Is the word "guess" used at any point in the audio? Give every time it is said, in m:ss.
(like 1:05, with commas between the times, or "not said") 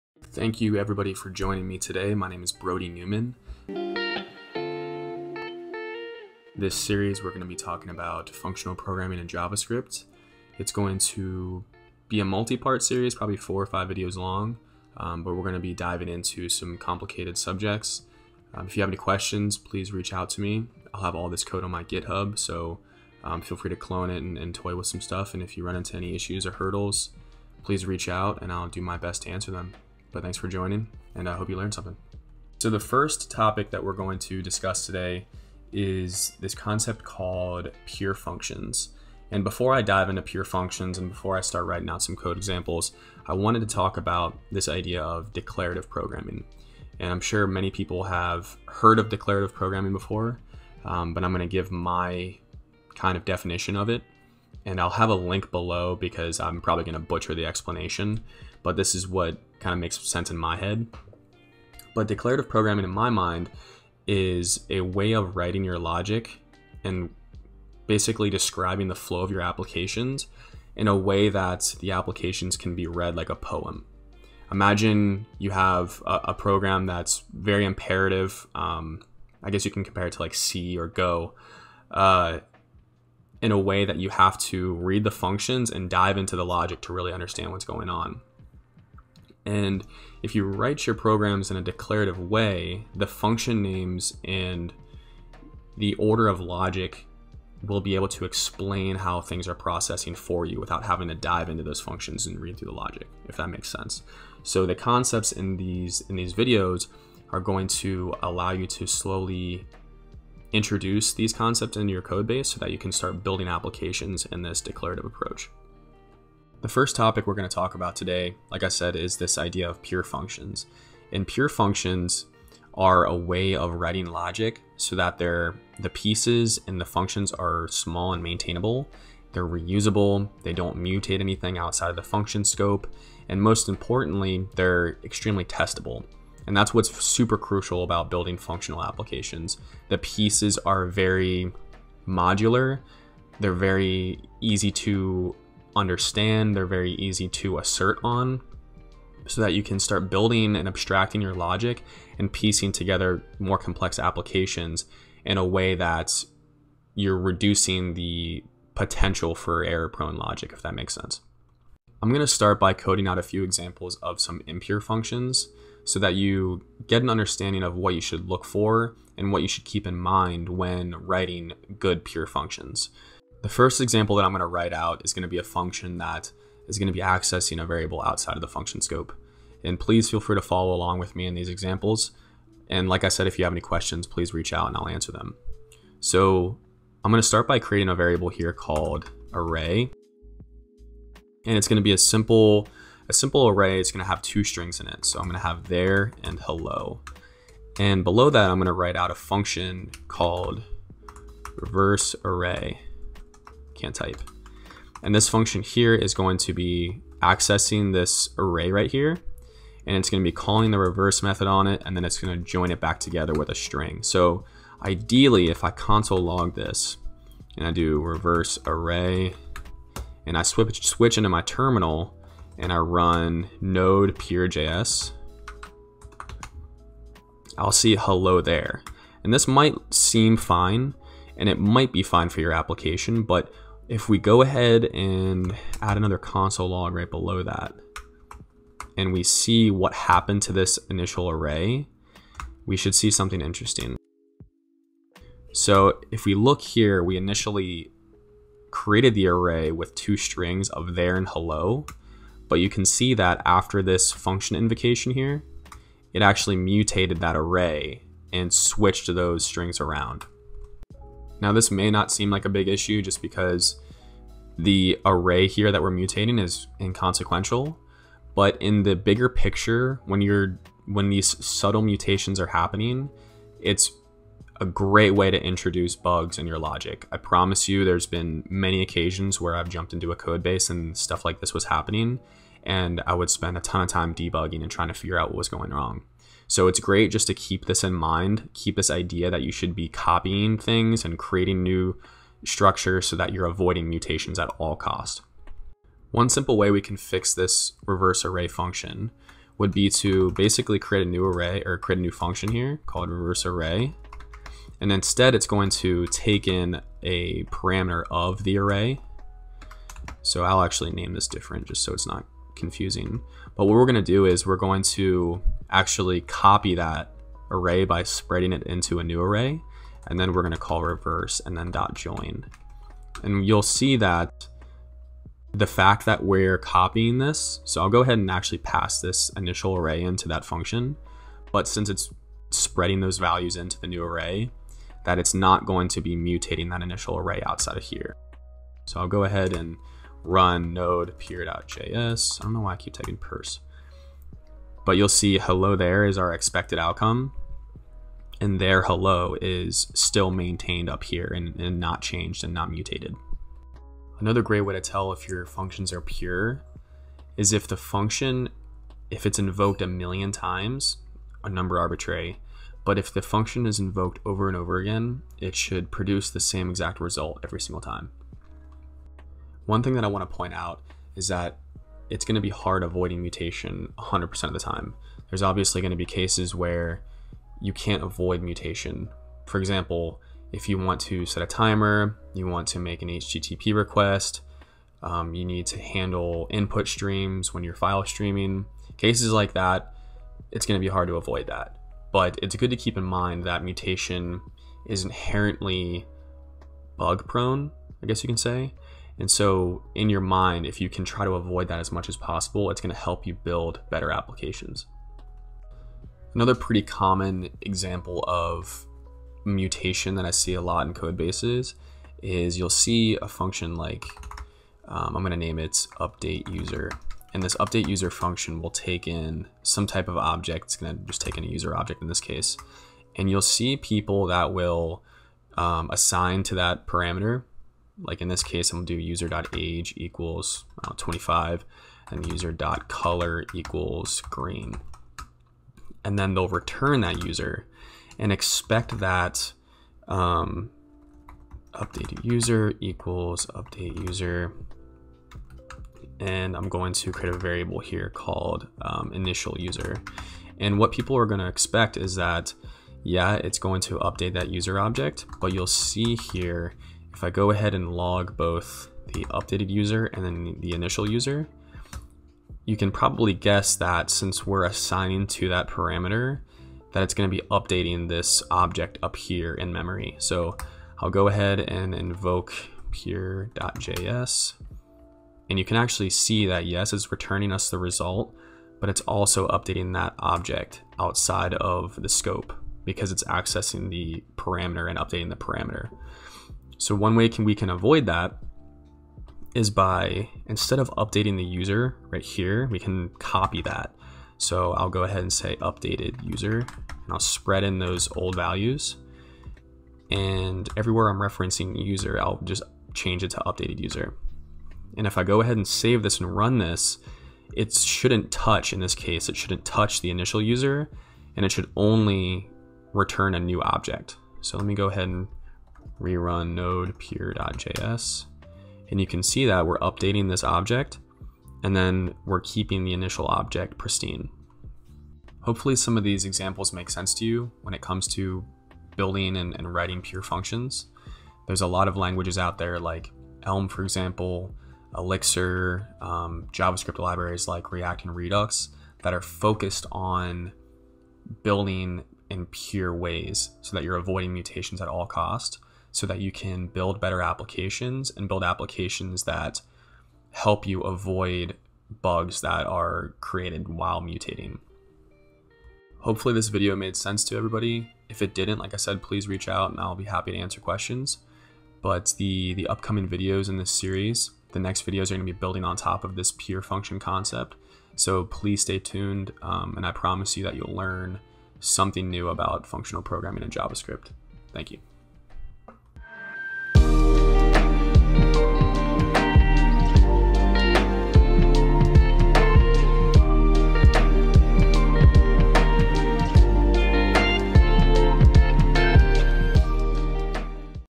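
1:19, 6:38, 7:43.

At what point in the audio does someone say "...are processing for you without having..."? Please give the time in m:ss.
1:39.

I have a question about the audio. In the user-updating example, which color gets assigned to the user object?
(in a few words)
green.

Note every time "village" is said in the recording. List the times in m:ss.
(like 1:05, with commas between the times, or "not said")
not said.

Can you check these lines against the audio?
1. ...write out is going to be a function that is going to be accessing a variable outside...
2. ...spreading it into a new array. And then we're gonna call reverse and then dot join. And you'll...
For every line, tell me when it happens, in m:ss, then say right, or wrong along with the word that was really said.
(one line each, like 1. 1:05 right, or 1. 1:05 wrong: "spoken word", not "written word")
1. 2:54 right
2. 5:18 right.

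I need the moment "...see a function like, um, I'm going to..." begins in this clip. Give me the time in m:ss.
6:52.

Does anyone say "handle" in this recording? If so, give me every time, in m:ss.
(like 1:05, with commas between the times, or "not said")
6:25.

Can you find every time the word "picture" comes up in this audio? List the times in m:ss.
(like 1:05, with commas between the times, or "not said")
4:29.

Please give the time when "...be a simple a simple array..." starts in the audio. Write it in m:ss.
3:11.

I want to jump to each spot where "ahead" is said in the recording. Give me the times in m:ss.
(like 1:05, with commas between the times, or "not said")
3:54, 5:28, 5:39, 7:37, 7:51, 8:15, 8:25, 8:34.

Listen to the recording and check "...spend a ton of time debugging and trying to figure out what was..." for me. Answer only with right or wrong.
right.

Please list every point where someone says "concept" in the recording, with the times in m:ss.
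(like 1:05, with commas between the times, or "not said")
0:36, 1:44, 1:51, 9:26.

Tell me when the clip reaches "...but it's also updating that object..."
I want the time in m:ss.
7:58.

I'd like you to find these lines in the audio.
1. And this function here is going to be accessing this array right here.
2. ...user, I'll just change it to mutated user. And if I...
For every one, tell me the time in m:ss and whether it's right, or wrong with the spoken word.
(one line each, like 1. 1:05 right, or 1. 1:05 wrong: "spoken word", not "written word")
1. 3:25 right
2. 8:21 wrong: "updated", not "mutated".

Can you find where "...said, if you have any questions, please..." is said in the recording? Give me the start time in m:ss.
3:03.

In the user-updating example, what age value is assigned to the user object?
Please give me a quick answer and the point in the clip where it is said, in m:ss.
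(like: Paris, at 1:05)
25, at 7:10.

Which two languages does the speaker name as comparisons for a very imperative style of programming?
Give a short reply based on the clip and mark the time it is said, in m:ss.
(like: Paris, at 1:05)
C or Go, at 1:20.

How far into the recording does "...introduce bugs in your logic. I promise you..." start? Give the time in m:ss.
4:35.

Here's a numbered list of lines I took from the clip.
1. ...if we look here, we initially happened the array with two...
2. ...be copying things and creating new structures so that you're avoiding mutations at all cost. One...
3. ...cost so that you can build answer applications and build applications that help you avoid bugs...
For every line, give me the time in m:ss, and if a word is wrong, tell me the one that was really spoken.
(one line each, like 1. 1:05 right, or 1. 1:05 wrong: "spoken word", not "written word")
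1. 4:06 wrong: "created", not "happened"
2. 4:49 right
3. 9:05 wrong: "better", not "answer".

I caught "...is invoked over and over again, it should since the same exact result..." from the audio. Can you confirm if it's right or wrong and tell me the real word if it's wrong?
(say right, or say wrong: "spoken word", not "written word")
wrong: "produce", not "since".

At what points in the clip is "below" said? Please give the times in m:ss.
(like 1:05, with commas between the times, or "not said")
0:55, 3:18, 3:57.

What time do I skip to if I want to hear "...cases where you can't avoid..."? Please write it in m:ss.
6:16.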